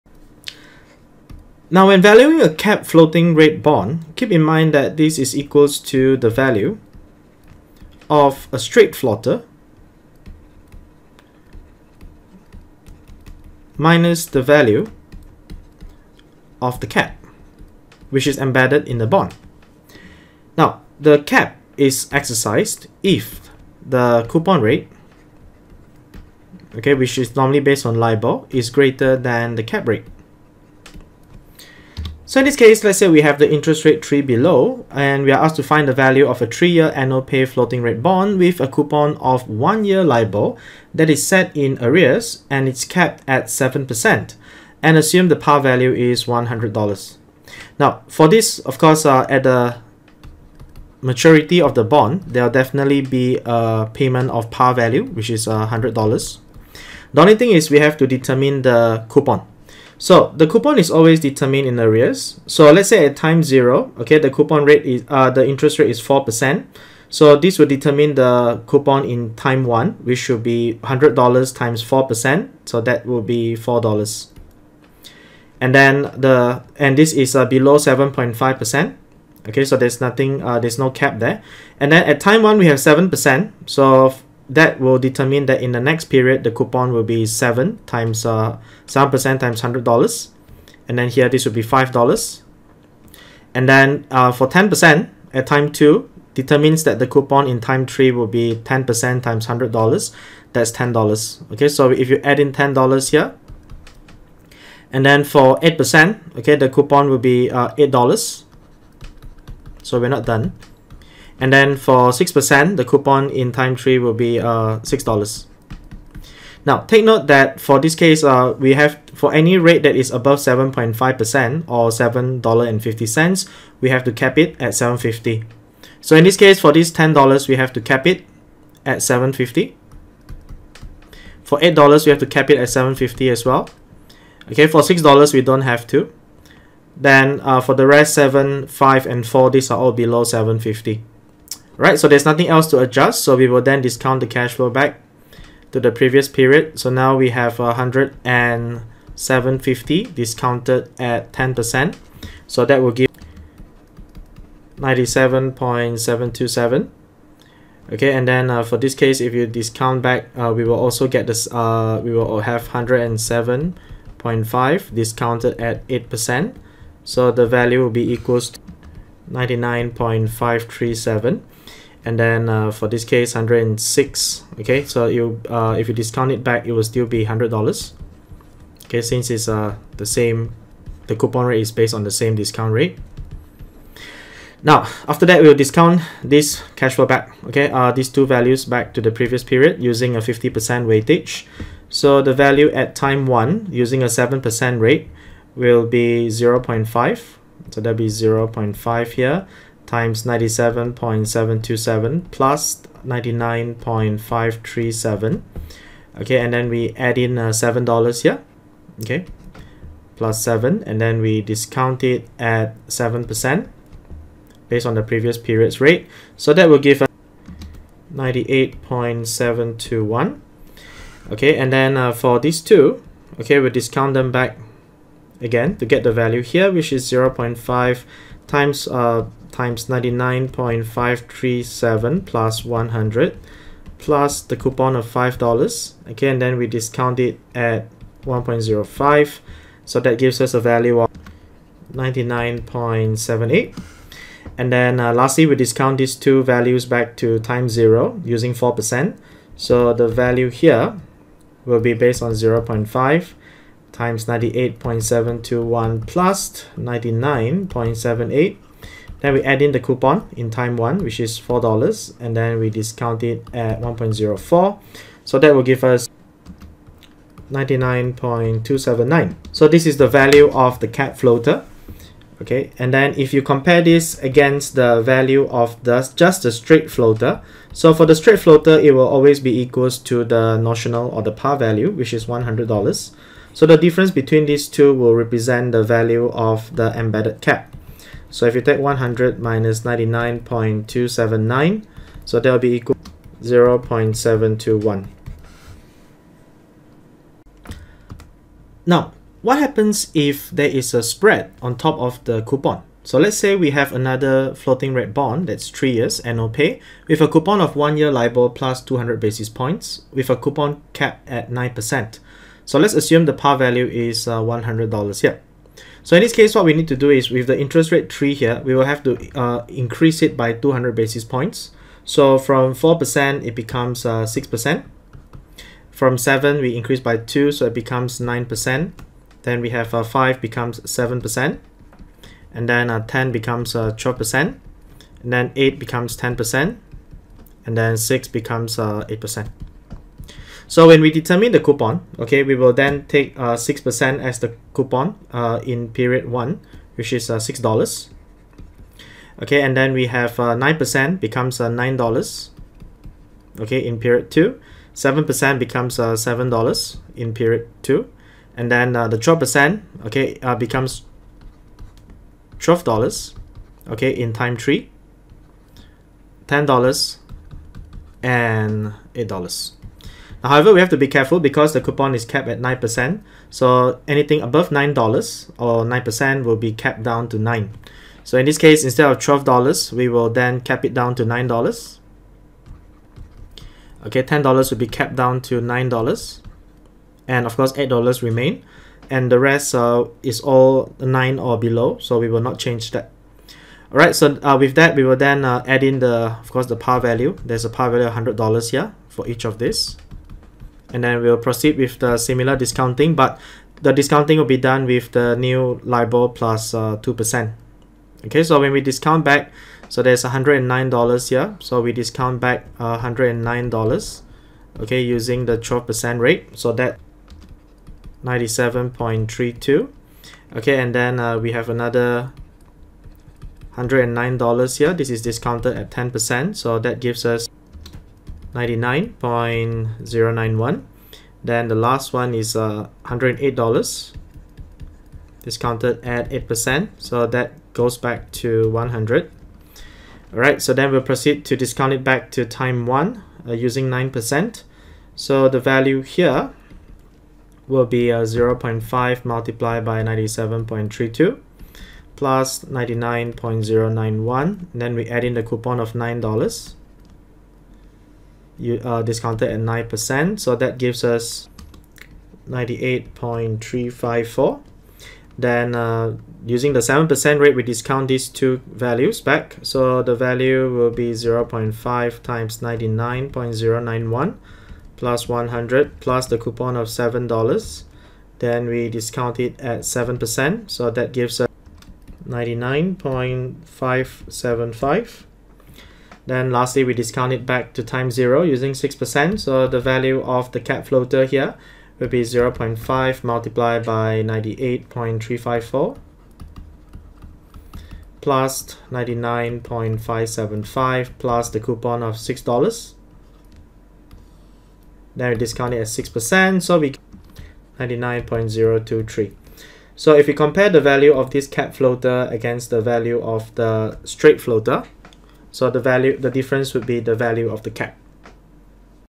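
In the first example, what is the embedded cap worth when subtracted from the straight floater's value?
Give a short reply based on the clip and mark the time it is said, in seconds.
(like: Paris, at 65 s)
0.721, at 293 s.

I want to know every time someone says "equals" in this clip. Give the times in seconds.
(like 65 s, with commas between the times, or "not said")
5 s, 168 s, 279 s, 292 s.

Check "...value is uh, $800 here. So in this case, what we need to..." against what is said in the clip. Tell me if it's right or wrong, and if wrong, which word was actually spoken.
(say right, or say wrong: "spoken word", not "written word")
wrong: "100", not "800".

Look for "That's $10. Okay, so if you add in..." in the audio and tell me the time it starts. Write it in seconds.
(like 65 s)
100 s.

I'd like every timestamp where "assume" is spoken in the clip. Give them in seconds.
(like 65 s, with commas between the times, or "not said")
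44 s, 312 s.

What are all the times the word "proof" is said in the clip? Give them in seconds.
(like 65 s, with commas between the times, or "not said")
not said.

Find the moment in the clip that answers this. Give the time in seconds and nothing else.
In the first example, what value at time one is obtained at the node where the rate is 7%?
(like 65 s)
218 s.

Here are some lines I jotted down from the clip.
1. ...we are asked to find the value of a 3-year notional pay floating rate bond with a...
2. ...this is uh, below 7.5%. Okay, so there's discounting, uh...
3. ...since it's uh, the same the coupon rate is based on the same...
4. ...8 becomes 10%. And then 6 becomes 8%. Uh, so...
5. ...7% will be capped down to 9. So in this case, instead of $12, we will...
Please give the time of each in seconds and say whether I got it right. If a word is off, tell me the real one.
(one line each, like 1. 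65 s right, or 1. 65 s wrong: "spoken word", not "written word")
1. 35 s wrong: "annual", not "notional"
2. 76 s wrong: "nothing", not "discounting"
3. 179 s right
4. 335 s right
5. 375 s wrong: "9", not "7".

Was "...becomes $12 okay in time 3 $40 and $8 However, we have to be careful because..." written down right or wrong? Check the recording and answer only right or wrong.
wrong.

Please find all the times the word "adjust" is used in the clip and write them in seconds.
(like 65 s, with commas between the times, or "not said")
142 s.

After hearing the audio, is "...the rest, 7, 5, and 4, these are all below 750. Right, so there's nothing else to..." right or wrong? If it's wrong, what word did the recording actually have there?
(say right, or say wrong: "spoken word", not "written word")
right.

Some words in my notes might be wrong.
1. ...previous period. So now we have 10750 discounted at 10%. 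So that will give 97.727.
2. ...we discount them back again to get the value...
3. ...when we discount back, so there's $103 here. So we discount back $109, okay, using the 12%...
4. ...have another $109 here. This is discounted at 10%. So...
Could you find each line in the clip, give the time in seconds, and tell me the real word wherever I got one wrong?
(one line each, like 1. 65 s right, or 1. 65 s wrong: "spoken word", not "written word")
1. 145 s right
2. 223 s right
3. 408 s wrong: "109", not "103"
4. 421 s right.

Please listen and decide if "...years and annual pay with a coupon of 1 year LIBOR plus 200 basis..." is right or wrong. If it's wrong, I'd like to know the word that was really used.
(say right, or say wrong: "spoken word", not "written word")
right.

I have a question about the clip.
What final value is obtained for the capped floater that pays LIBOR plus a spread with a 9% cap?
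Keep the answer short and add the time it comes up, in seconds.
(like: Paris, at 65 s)
99.023, at 507 s.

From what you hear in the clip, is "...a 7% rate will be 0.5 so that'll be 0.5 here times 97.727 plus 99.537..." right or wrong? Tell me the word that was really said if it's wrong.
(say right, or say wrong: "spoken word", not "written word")
right.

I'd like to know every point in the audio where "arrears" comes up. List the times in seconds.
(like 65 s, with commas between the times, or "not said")
41 s, 61 s.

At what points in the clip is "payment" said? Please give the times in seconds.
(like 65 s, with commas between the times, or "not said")
53 s.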